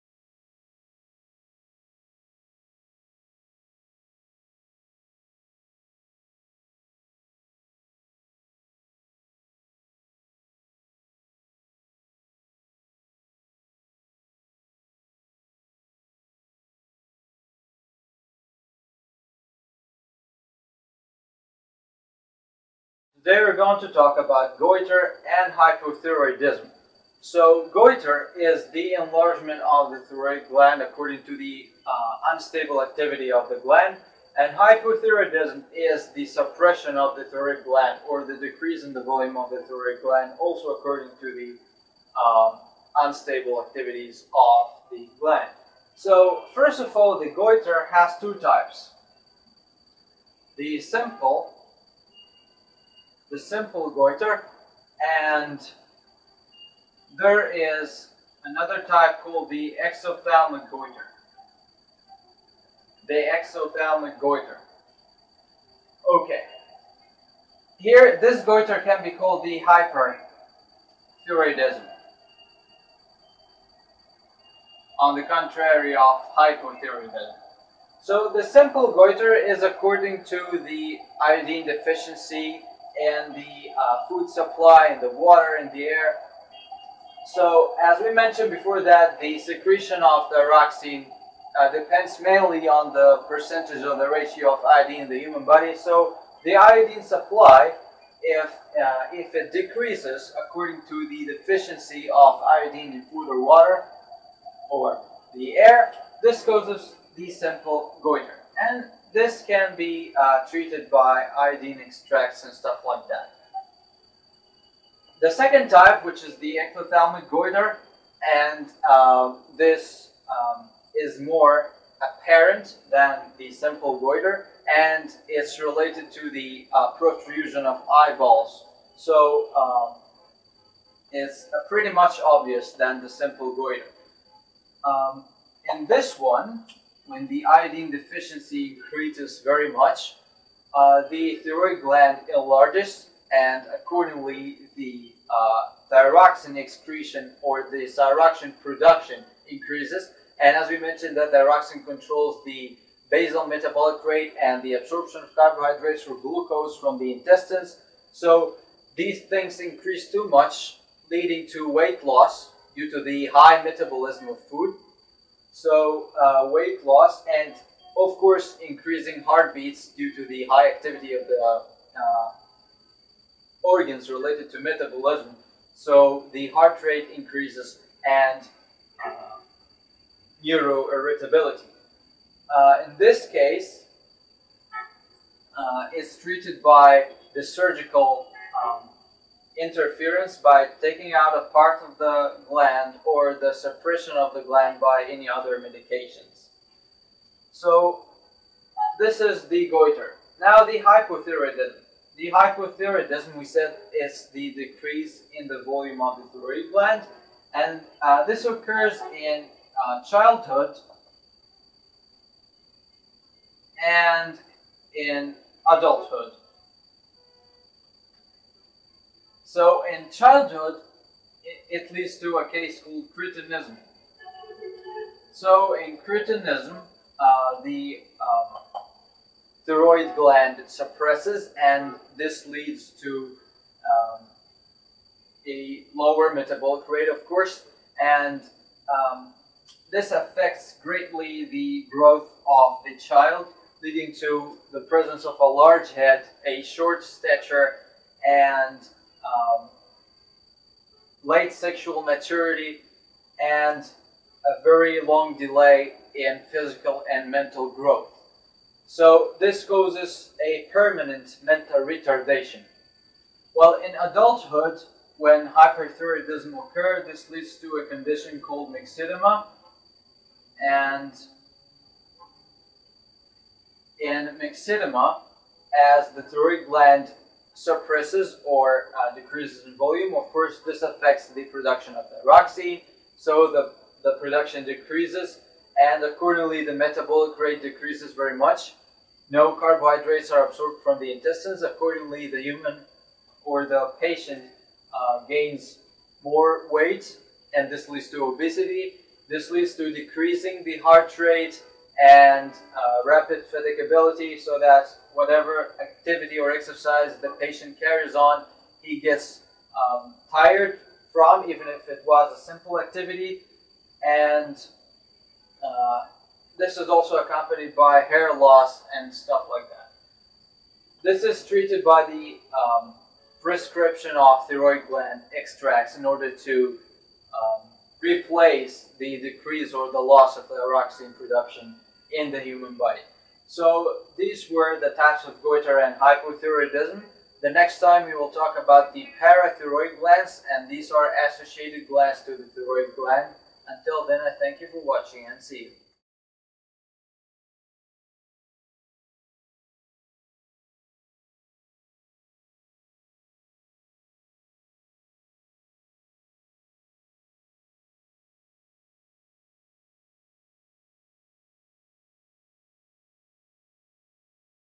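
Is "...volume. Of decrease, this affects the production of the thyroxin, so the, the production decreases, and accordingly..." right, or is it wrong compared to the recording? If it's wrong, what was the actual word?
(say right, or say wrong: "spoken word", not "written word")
wrong: "course", not "decrease".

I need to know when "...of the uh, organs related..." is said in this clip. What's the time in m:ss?
2:51.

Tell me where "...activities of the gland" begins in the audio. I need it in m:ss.
0:43.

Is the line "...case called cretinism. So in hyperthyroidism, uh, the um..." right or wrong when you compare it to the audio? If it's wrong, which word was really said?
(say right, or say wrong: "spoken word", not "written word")
wrong: "cretinism", not "hyperthyroidism".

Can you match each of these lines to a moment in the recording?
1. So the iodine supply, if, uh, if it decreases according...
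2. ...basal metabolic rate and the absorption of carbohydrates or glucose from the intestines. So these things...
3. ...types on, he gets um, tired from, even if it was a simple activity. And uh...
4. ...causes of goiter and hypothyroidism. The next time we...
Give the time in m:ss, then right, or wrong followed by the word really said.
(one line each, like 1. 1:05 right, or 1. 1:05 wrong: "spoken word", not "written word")
1. 1:35 right
2. 2:33 right
3. 5:07 wrong: "carries", not "types"
4. 5:34 wrong: "types", not "causes".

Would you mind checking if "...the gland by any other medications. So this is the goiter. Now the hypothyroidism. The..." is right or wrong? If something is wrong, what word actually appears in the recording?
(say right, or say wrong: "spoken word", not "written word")
right.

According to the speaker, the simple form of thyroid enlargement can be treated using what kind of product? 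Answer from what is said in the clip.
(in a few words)
Iodine extracts.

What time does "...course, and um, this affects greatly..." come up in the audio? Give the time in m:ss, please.
3:57.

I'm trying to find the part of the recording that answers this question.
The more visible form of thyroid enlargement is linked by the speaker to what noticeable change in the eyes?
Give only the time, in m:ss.
2:06.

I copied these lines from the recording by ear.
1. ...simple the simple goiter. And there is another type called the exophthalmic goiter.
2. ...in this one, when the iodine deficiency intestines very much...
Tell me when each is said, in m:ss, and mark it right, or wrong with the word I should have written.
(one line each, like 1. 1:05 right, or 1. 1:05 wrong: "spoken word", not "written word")
1. 0:50 right
2. 2:15 wrong: "increases", not "intestines".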